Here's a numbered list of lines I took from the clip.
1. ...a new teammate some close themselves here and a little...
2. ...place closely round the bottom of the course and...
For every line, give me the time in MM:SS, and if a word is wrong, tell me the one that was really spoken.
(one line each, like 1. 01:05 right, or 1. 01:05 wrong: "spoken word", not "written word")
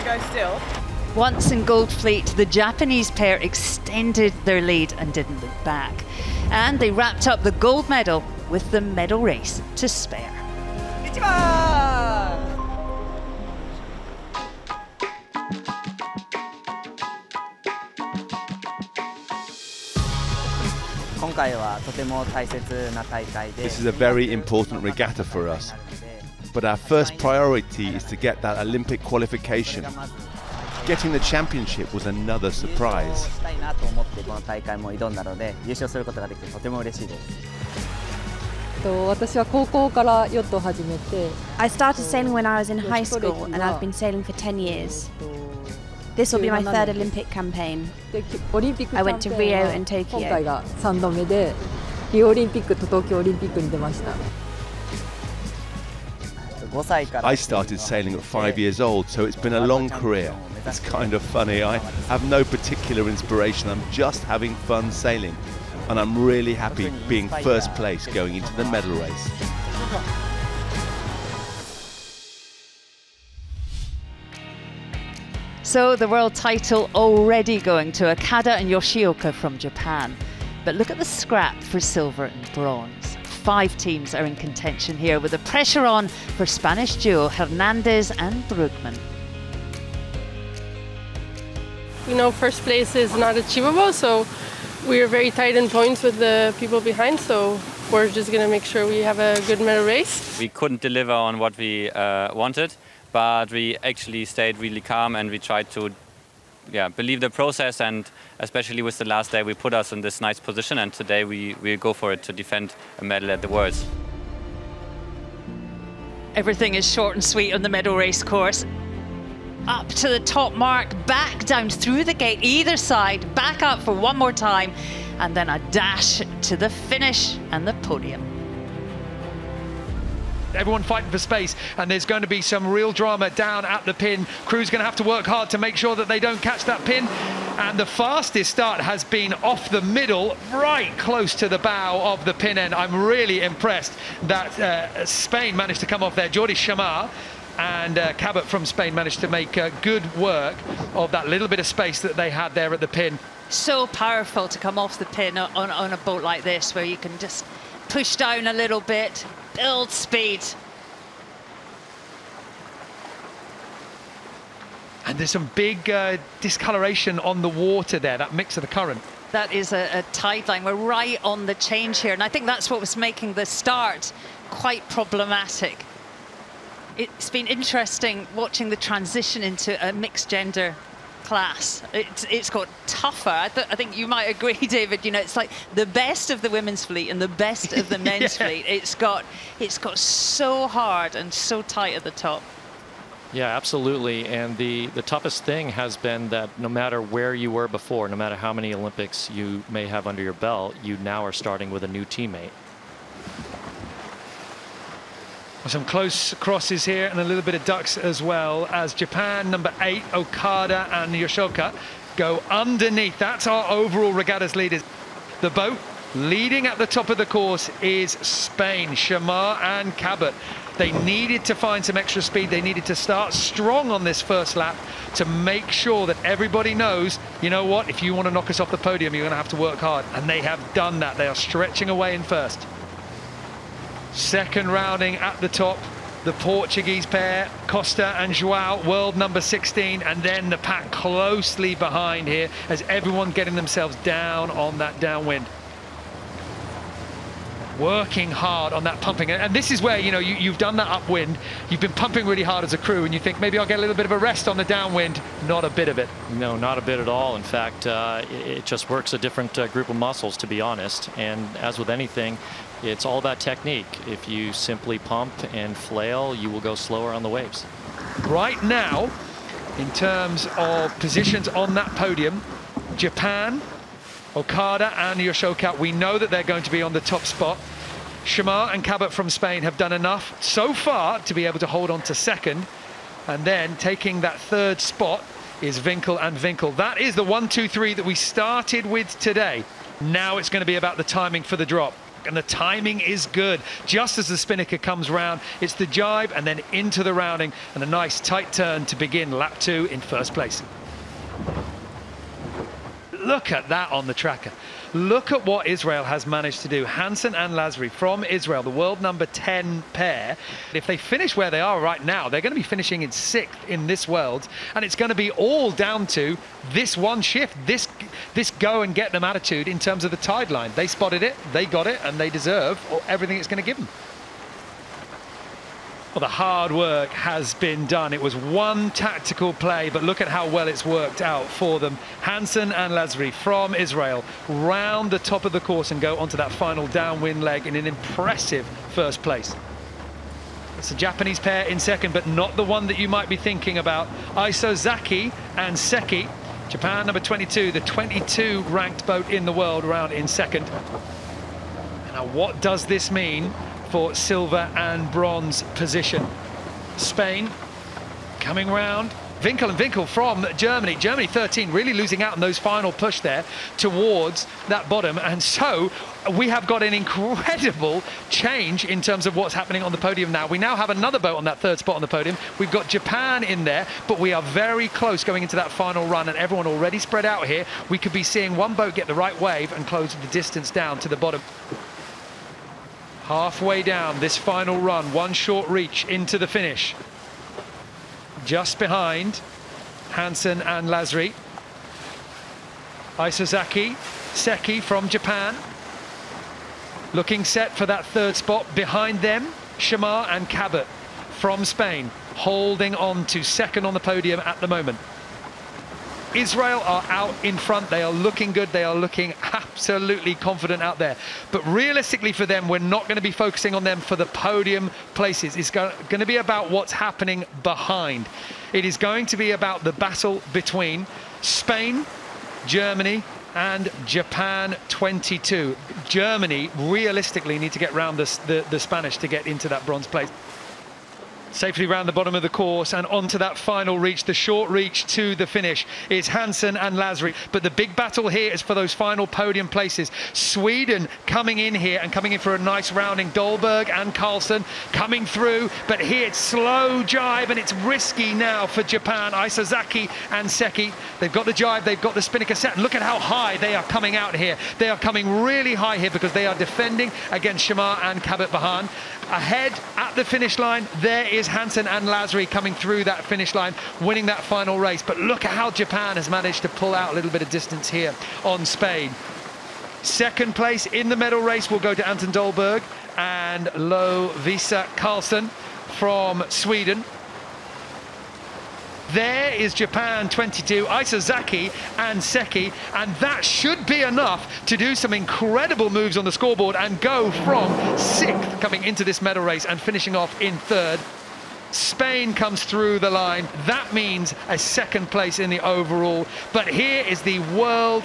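1. 03:21 wrong: "crosses", not "themselves"
2. 07:10 wrong: "safely", not "closely".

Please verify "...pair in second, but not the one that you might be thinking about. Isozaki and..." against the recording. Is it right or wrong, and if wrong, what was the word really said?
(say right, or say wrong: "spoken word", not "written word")
right.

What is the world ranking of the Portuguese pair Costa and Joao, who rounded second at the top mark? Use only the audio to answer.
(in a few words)
16.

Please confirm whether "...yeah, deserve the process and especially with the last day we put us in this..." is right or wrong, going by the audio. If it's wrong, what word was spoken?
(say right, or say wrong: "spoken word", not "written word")
wrong: "believe", not "deserve".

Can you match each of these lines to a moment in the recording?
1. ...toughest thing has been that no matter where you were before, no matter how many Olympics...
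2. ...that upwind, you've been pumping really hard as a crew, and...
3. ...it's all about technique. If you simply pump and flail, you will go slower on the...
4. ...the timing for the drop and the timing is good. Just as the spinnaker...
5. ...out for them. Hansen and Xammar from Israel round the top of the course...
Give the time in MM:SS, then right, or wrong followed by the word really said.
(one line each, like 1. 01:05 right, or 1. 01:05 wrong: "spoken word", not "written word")
1. 03:15 right
2. 04:10 right
3. 04:22 right
4. 04:50 right
5. 05:31 wrong: "Lasry", not "Xammar".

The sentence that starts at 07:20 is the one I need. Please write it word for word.
Sweden coming in here and coming in for a nice rounding.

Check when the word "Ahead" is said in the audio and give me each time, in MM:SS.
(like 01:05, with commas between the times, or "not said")
07:39.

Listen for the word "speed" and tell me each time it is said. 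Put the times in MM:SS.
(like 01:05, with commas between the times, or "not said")
02:39, 03:42.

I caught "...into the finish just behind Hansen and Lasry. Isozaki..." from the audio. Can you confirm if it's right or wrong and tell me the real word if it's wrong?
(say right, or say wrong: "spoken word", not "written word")
right.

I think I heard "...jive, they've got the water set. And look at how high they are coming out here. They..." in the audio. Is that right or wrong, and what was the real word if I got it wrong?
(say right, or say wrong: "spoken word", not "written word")
wrong: "spinnaker", not "water".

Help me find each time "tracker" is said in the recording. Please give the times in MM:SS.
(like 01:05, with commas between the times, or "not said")
05:04.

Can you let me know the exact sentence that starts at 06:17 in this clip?
We could be seeing one boat get the right wave and close the distance down to the bottom.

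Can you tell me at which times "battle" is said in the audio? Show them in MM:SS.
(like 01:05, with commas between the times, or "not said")
06:59, 07:17.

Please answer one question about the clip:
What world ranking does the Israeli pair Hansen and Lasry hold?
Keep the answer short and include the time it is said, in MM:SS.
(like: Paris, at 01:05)
10, at 05:08.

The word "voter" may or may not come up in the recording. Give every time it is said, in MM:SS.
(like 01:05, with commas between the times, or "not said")
not said.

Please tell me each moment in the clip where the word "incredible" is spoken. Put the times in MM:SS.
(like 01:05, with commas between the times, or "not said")
06:06, 08:05.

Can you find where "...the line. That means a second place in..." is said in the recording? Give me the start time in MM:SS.
08:12.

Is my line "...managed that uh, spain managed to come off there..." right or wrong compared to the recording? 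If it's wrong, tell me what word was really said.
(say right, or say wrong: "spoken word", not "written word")
wrong: "impressed", not "managed".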